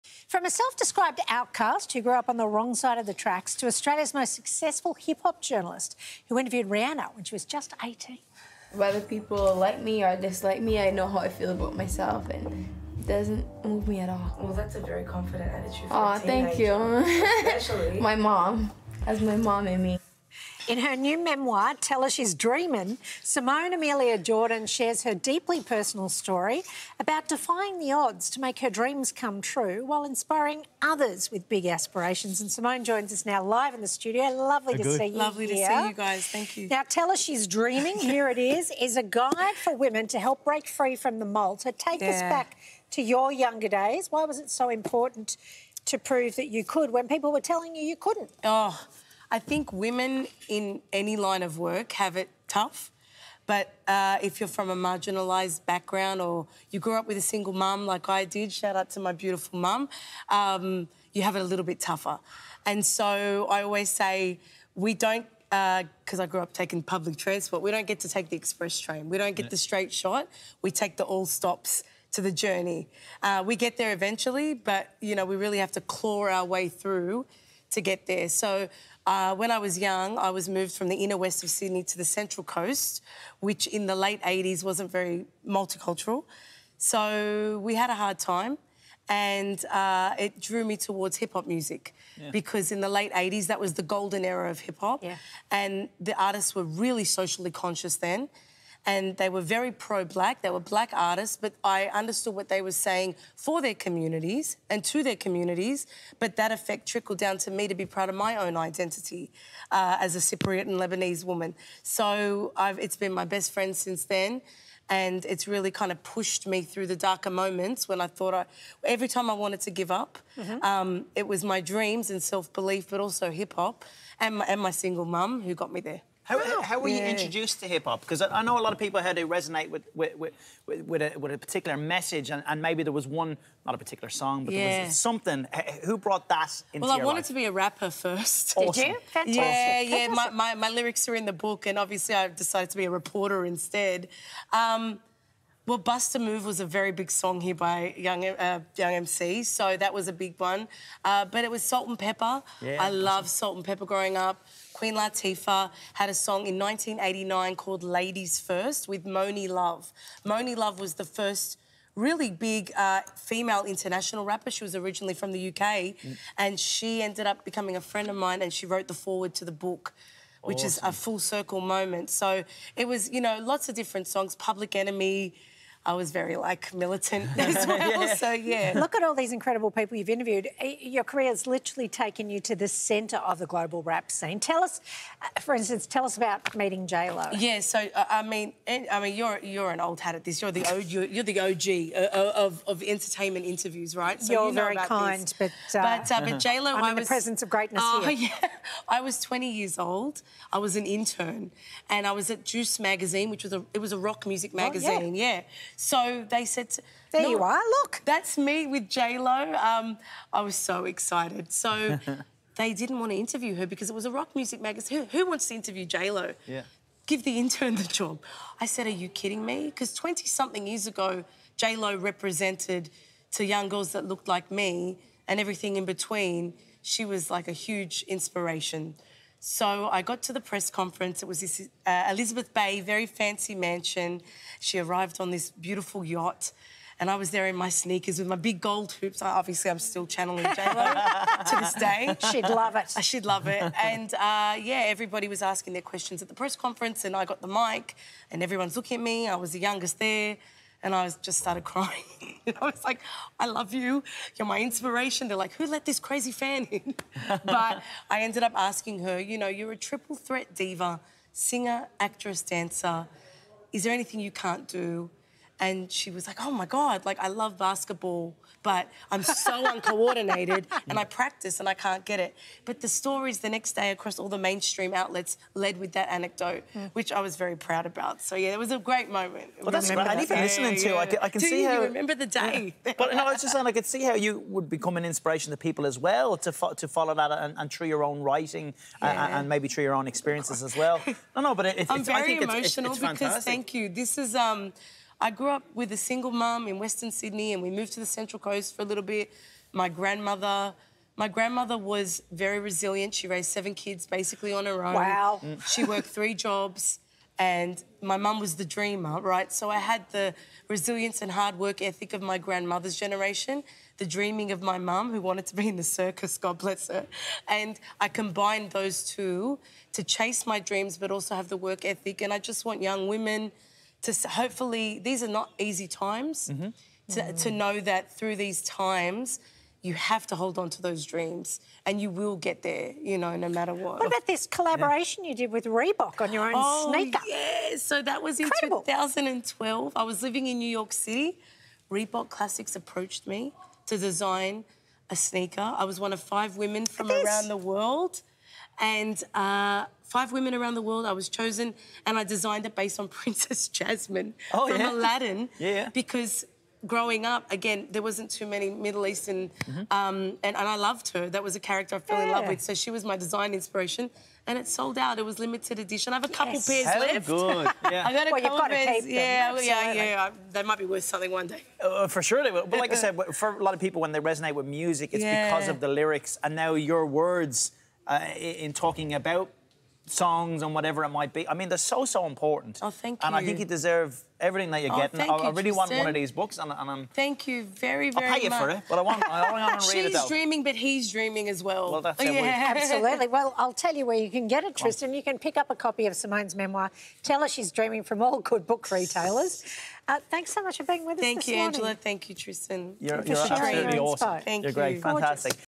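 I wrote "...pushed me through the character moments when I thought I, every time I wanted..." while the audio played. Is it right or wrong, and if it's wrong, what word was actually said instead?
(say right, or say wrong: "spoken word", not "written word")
wrong: "darker", not "character".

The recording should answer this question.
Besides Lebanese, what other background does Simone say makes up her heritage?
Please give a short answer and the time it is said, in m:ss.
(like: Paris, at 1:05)
Cypriot, at 1:50.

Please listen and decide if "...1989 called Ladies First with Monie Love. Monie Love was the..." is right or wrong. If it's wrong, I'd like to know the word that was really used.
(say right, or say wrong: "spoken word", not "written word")
right.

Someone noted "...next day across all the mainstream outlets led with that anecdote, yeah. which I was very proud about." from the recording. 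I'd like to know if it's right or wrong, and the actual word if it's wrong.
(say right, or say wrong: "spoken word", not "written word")
right.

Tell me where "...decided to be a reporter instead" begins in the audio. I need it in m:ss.
2:22.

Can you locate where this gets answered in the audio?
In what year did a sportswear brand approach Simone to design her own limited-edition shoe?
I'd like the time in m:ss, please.
5:38.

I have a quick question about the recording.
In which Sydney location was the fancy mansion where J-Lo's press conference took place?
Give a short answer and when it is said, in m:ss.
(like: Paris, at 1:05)
Elizabeth Bay, at 3:52.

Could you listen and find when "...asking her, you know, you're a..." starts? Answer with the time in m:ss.
4:18.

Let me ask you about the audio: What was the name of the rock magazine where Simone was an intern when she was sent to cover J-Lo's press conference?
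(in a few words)
Juice.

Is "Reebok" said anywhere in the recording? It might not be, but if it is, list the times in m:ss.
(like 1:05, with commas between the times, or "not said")
5:35, 5:41.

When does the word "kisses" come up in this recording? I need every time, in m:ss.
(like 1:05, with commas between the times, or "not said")
not said.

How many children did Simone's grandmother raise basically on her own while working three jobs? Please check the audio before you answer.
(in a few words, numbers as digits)
7.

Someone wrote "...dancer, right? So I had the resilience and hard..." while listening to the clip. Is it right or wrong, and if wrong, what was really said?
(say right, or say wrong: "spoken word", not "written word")
wrong: "dreamer", not "dancer".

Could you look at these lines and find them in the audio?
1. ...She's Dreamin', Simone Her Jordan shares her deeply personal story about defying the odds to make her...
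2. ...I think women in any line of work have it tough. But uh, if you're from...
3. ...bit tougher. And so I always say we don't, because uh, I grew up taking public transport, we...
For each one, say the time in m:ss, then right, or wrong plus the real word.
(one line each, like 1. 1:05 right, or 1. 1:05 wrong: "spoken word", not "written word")
1. 0:22 wrong: "Amelia", not "Her"
2. 0:49 right
3. 1:01 right.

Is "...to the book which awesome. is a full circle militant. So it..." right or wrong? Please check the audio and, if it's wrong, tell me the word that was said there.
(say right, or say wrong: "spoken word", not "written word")
wrong: "moment", not "militant".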